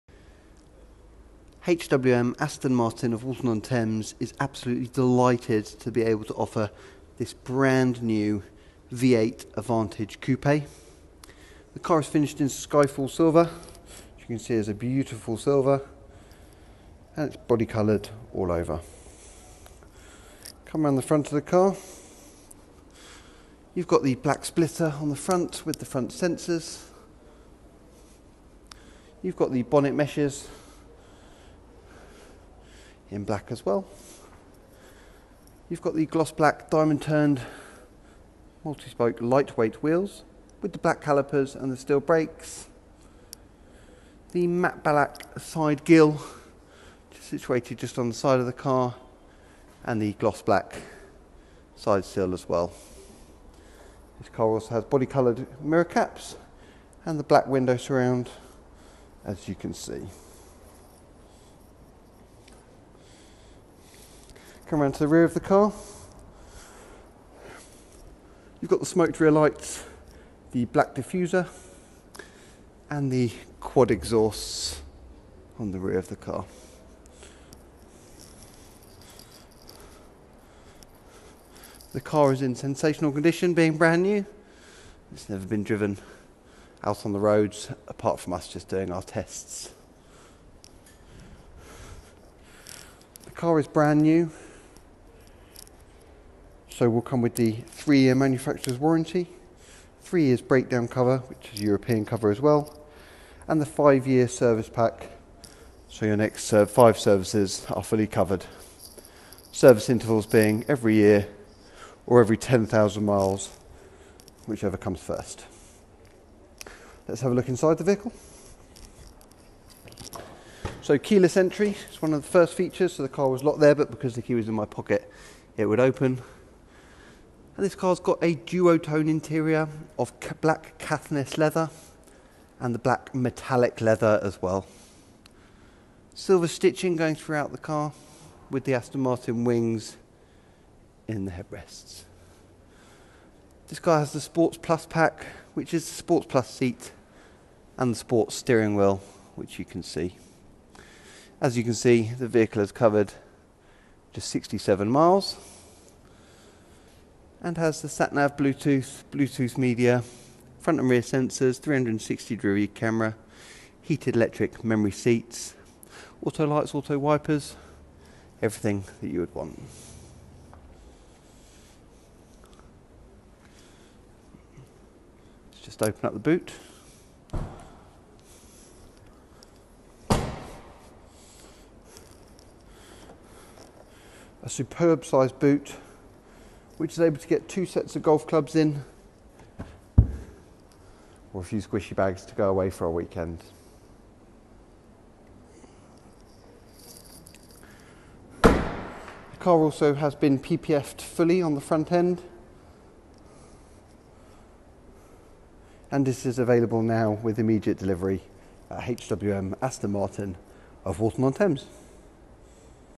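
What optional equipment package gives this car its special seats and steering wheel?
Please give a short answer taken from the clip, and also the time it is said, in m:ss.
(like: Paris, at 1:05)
Sports Plus pack, at 2:24.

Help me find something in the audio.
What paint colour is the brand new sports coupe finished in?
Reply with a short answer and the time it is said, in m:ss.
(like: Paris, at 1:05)
Skyfall Silver, at 0:12.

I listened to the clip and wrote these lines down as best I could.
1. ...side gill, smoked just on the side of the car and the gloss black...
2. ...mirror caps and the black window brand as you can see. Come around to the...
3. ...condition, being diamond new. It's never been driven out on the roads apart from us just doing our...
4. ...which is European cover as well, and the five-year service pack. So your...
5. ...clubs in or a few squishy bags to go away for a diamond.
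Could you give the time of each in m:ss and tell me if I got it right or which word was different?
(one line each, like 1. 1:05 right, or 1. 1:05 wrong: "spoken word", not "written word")
1. 0:45 wrong: "situated", not "smoked"
2. 0:55 wrong: "surround", not "brand"
3. 1:23 wrong: "brand", not "diamond"
4. 1:41 right
5. 3:08 wrong: "weekend", not "diamond".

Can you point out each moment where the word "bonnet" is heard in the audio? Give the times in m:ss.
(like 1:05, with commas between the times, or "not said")
0:29.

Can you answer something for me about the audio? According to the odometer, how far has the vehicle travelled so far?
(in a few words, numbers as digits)
67 miles.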